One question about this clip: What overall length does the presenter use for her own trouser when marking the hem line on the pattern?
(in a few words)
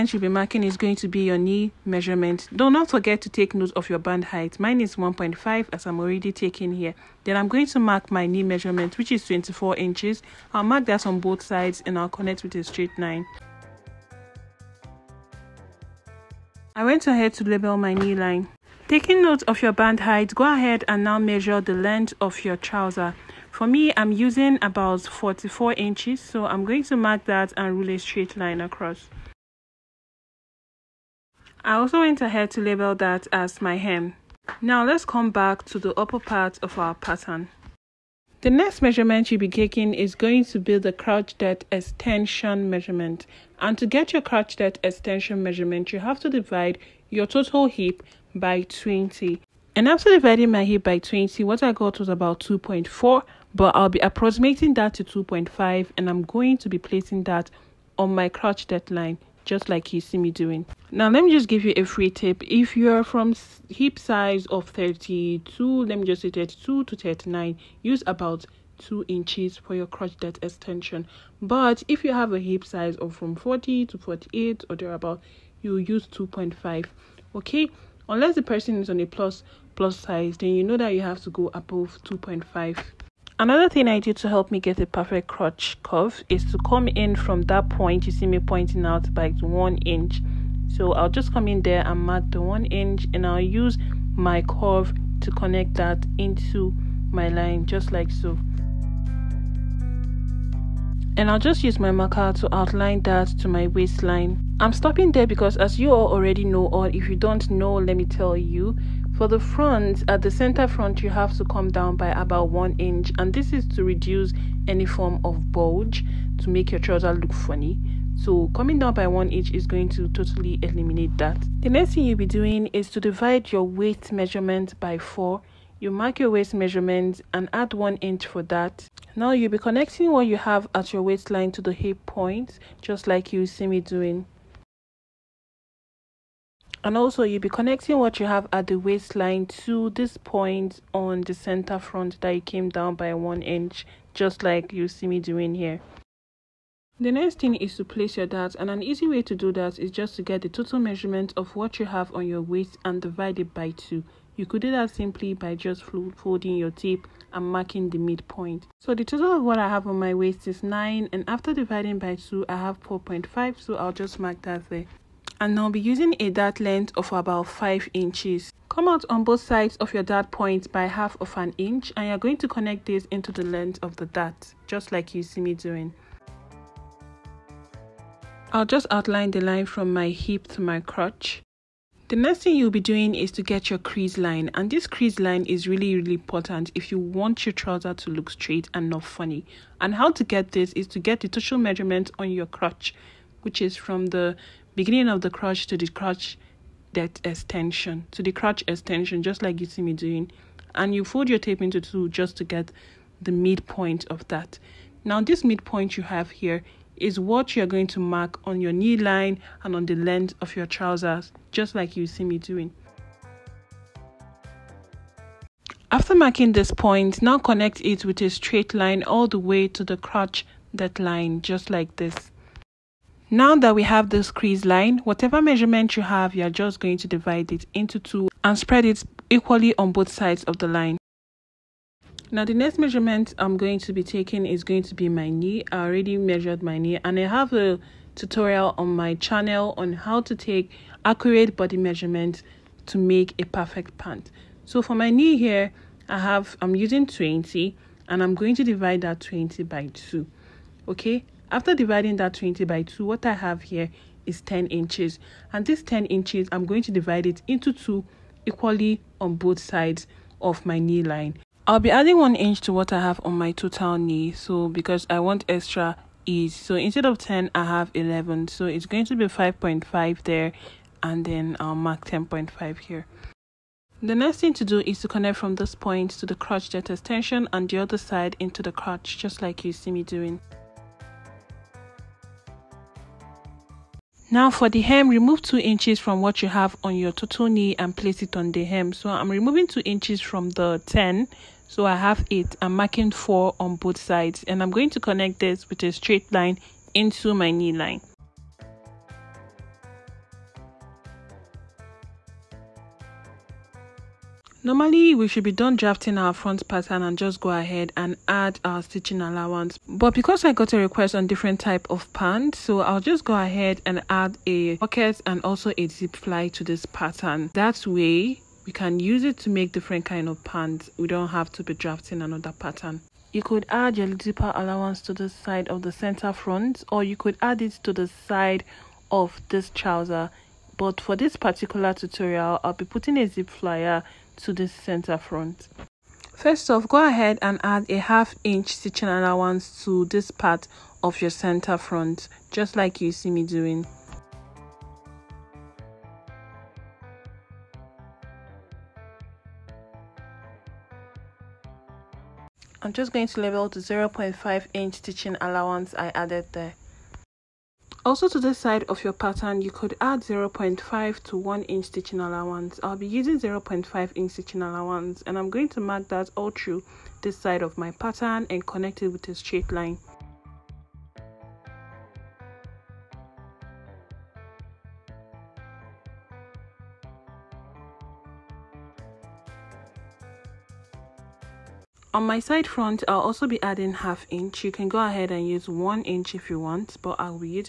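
44 inches.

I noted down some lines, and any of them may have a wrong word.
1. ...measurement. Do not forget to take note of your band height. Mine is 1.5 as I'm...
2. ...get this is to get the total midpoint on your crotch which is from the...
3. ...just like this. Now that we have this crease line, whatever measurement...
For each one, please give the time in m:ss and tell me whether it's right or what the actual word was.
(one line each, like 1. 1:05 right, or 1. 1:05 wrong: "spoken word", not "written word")
1. 0:01 right
2. 3:10 wrong: "measurement", not "midpoint"
3. 3:41 right.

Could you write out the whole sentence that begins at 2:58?
I'll just outline the line from my hip to my crotch.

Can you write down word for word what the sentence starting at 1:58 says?
So coming down by one inch is going to totally eliminate that.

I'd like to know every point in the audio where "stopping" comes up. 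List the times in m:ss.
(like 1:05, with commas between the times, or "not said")
1:44.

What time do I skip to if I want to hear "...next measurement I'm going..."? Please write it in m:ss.
3:52.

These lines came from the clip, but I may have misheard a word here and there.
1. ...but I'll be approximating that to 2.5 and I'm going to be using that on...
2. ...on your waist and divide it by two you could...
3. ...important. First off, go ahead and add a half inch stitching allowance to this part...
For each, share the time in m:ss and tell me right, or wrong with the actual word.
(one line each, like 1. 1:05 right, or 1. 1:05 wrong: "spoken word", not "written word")
1. 0:53 wrong: "placing", not "using"
2. 2:32 right
3. 5:35 wrong: "front", not "important".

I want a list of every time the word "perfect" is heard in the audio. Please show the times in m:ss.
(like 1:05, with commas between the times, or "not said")
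1:24, 4:03.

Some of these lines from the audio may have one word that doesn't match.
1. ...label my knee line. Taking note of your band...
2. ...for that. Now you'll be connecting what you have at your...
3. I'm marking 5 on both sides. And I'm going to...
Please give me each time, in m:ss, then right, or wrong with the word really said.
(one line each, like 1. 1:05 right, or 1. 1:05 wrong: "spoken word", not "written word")
1. 0:17 right
2. 2:08 right
3. 4:52 wrong: "4", not "5".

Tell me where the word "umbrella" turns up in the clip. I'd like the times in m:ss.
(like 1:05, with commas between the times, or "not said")
not said.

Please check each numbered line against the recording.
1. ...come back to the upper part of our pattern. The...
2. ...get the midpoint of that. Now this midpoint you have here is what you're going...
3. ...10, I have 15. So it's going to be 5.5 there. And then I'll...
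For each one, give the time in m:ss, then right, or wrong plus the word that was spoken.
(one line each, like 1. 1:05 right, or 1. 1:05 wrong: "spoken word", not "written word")
1. 0:35 right
2. 3:22 right
3. 4:27 wrong: "11", not "15".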